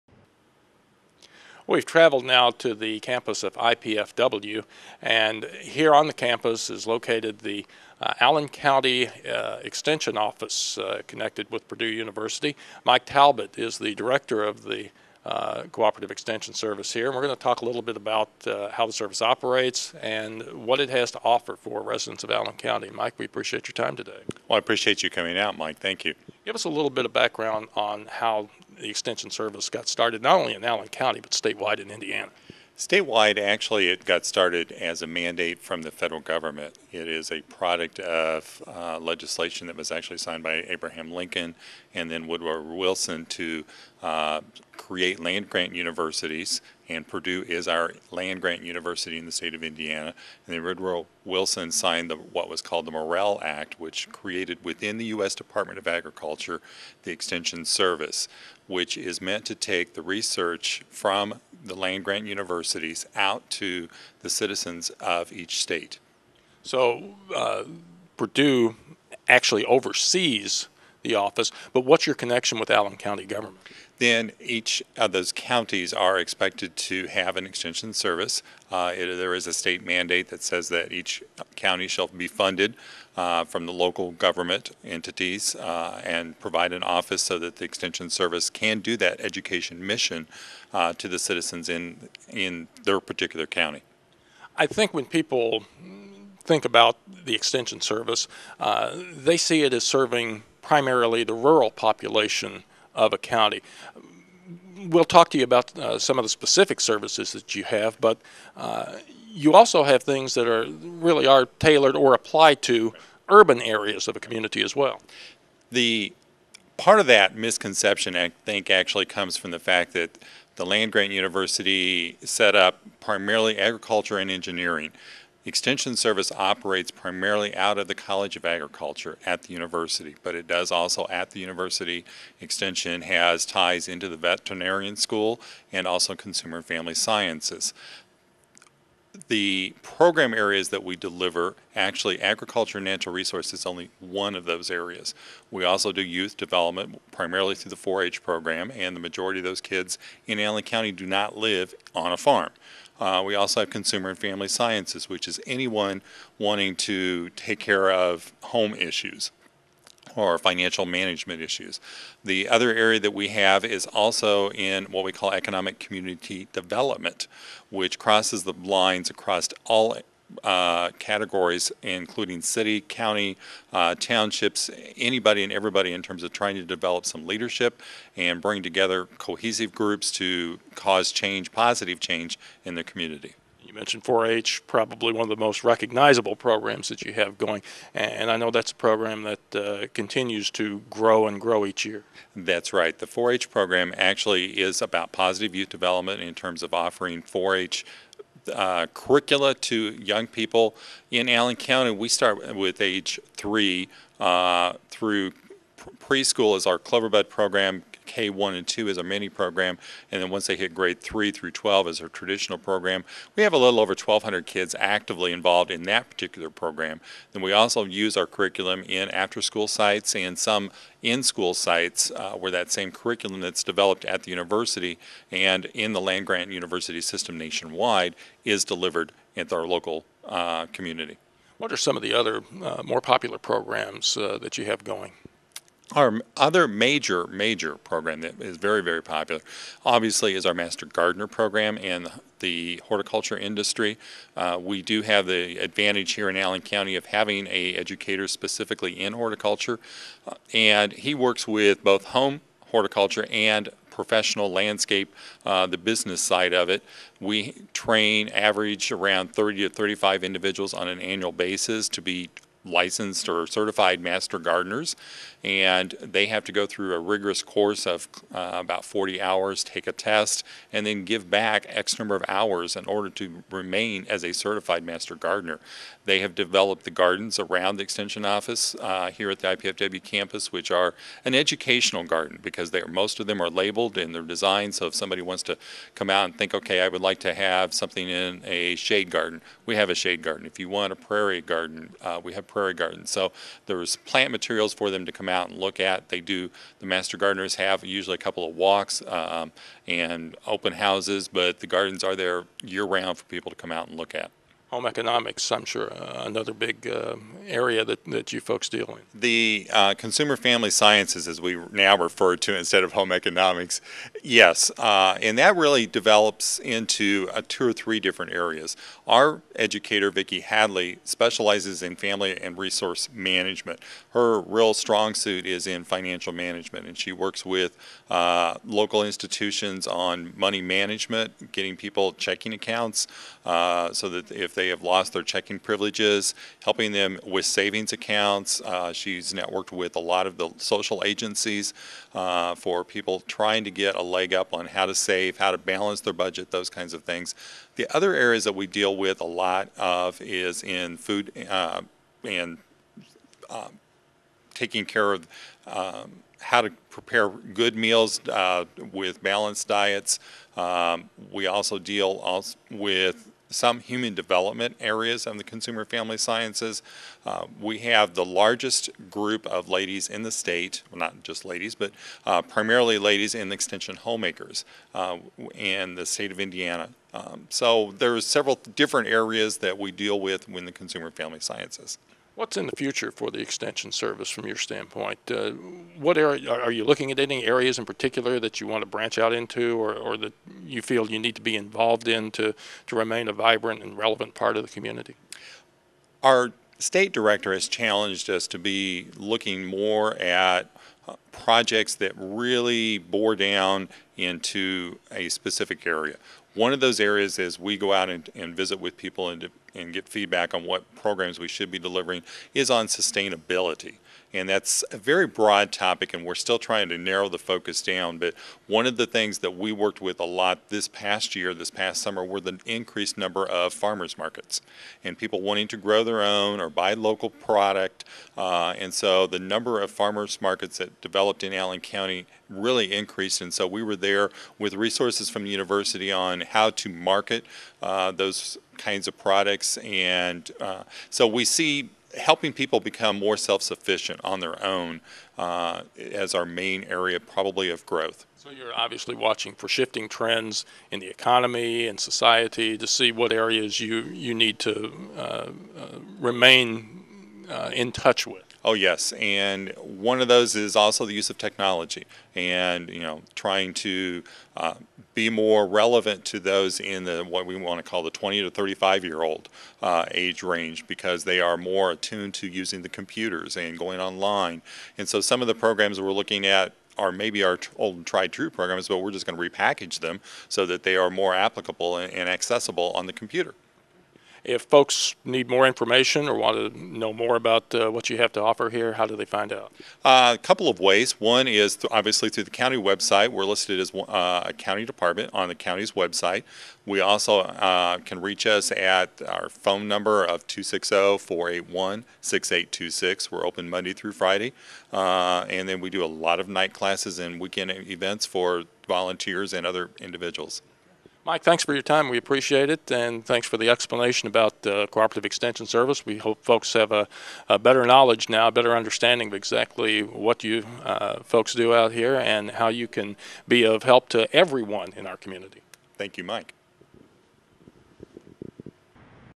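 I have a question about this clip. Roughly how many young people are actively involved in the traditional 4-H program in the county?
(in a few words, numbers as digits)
1,200.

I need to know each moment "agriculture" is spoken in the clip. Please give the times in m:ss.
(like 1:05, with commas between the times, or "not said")
0:55, 2:03, 2:08, 2:22.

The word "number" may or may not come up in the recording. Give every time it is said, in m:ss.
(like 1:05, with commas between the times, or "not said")
4:31, 7:03, 7:09, 8:19.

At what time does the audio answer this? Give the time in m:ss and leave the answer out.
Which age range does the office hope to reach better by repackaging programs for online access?
7:48.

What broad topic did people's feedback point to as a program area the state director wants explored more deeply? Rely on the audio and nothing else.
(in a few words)
sustainability.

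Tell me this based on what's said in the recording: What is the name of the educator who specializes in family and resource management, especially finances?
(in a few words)
Vicki Hadley.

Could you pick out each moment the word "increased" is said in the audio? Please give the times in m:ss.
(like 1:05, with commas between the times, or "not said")
7:02, 7:12.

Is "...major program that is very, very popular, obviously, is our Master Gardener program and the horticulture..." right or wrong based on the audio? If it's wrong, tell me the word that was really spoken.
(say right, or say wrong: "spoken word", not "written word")
right.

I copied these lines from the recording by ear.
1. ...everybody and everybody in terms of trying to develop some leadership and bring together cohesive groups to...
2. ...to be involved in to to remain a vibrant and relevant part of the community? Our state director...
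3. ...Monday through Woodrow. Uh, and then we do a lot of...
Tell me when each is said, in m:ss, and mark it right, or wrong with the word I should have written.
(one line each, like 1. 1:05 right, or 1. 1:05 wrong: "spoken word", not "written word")
1. 2:54 wrong: "anybody", not "everybody"
2. 6:31 right
3. 8:23 wrong: "Friday", not "Woodrow".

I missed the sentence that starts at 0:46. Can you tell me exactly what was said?
And Purdue is our land grant university in the state of Indiana.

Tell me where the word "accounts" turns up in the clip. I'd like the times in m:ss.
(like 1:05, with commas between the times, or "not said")
5:32, 5:37.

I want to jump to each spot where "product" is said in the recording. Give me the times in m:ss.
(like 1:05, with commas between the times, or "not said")
0:37, 7:07, 7:19.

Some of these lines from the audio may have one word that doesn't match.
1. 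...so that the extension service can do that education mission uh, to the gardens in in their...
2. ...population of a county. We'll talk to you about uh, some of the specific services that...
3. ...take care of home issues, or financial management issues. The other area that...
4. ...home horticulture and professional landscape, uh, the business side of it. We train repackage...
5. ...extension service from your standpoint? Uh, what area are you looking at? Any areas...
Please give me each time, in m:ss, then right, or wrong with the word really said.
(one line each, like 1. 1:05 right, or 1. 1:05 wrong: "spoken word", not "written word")
1. 1:27 wrong: "citizens", not "gardens"
2. 1:41 right
3. 2:37 right
4. 4:12 wrong: "average", not "repackage"
5. 6:23 right.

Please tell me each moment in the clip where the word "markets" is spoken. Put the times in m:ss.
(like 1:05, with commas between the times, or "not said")
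7:04, 7:10, 7:16.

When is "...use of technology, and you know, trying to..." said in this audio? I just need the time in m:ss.
7:41.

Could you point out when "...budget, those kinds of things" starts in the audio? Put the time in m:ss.
5:46.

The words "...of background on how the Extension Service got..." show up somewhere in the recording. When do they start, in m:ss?
0:27.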